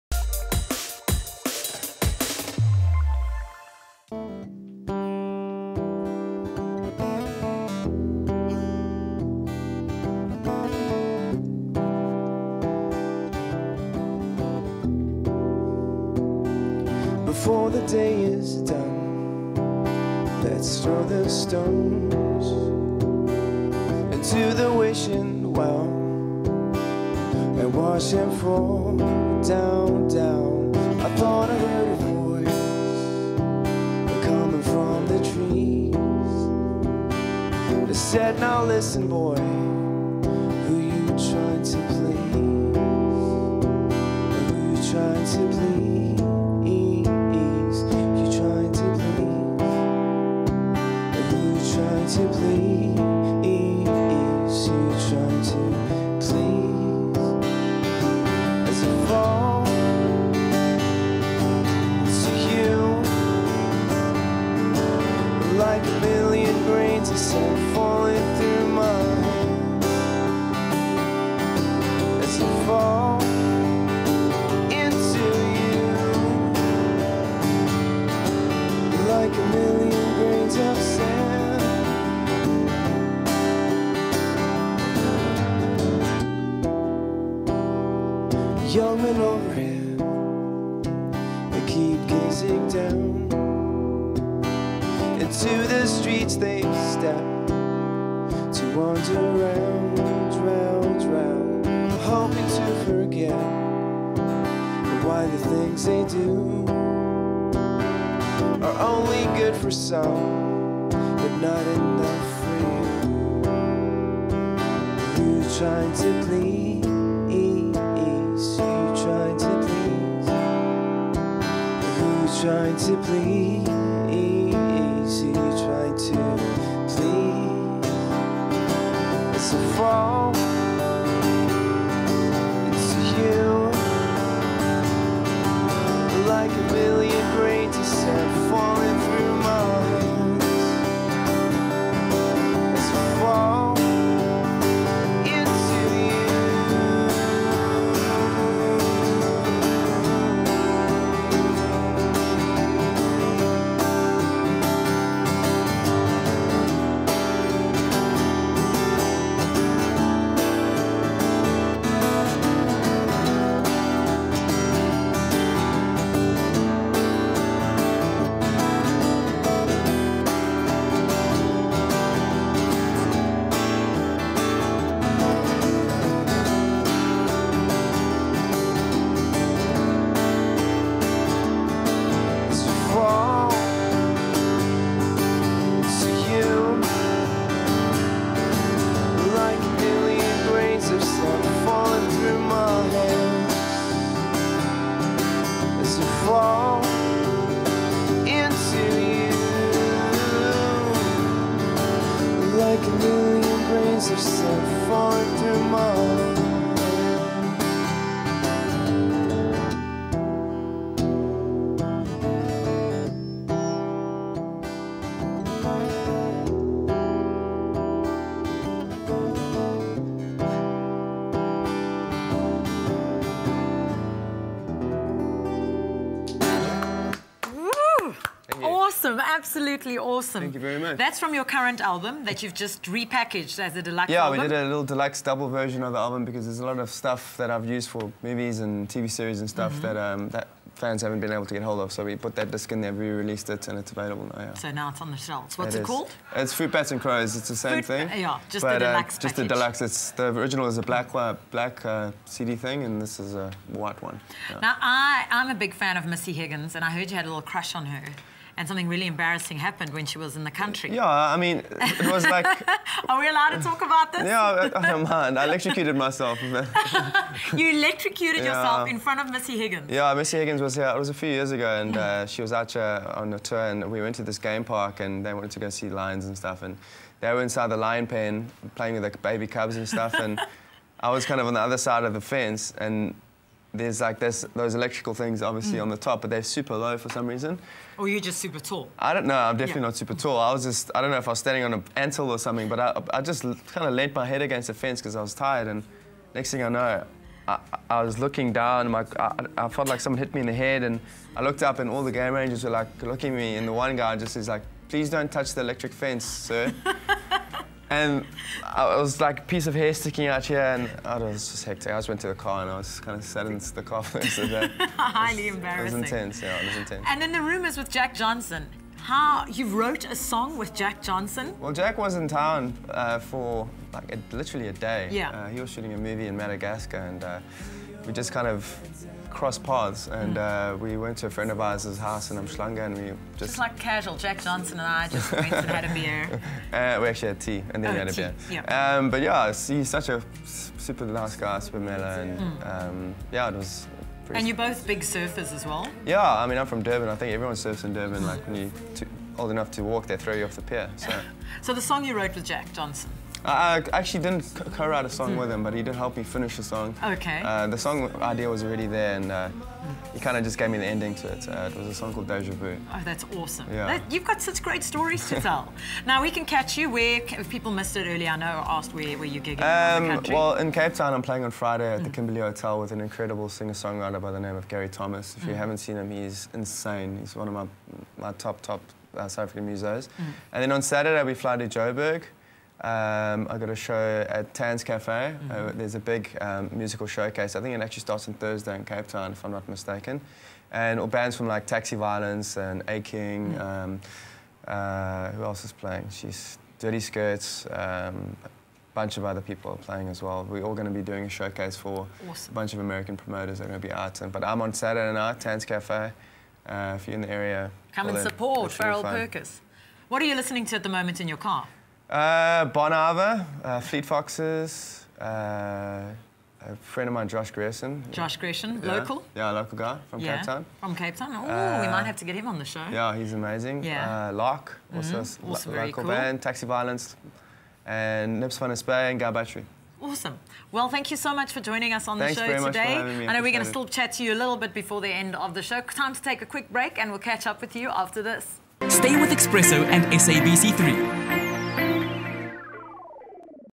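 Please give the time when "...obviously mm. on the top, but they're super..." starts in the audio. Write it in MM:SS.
04:45.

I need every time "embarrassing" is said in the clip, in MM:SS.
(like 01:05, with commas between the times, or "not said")
04:19, 05:15.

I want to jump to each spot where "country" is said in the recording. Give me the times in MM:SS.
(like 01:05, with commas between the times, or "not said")
04:20, 06:10.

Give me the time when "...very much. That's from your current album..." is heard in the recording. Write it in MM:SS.
03:50.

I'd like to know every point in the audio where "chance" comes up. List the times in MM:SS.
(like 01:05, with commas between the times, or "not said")
not said.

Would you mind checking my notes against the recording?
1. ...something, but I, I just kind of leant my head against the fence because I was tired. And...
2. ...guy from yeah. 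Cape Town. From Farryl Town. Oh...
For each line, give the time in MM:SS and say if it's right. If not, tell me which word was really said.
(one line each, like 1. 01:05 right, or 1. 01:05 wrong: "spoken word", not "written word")
1. 04:52 right
2. 06:59 wrong: "Cape", not "Farryl".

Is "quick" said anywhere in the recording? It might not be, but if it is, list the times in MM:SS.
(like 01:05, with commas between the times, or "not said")
07:16.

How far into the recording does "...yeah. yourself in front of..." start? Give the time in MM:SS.
04:28.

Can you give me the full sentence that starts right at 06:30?
And all bands from like Taxi Violence and A King.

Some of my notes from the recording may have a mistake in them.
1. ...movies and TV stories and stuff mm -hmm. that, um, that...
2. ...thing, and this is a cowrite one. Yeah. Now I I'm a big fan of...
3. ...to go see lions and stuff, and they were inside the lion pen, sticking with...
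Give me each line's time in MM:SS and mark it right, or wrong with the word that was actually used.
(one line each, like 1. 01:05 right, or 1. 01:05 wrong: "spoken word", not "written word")
1. 03:58 wrong: "series", not "stories"
2. 04:12 wrong: "white", not "cowrite"
3. 04:35 wrong: "playing", not "sticking".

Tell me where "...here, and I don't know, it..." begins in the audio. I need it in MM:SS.
05:10.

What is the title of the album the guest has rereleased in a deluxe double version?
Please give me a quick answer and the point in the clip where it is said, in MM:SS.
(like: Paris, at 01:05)
Fruit Bats and Crows, at 04:06.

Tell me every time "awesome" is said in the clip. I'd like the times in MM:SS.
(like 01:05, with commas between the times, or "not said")
03:49, 06:03, 06:42, 07:10.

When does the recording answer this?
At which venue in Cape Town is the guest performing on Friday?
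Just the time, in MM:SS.
06:12.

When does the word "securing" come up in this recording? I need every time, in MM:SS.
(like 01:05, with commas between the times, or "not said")
not said.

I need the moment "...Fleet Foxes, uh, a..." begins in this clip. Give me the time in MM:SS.
06:53.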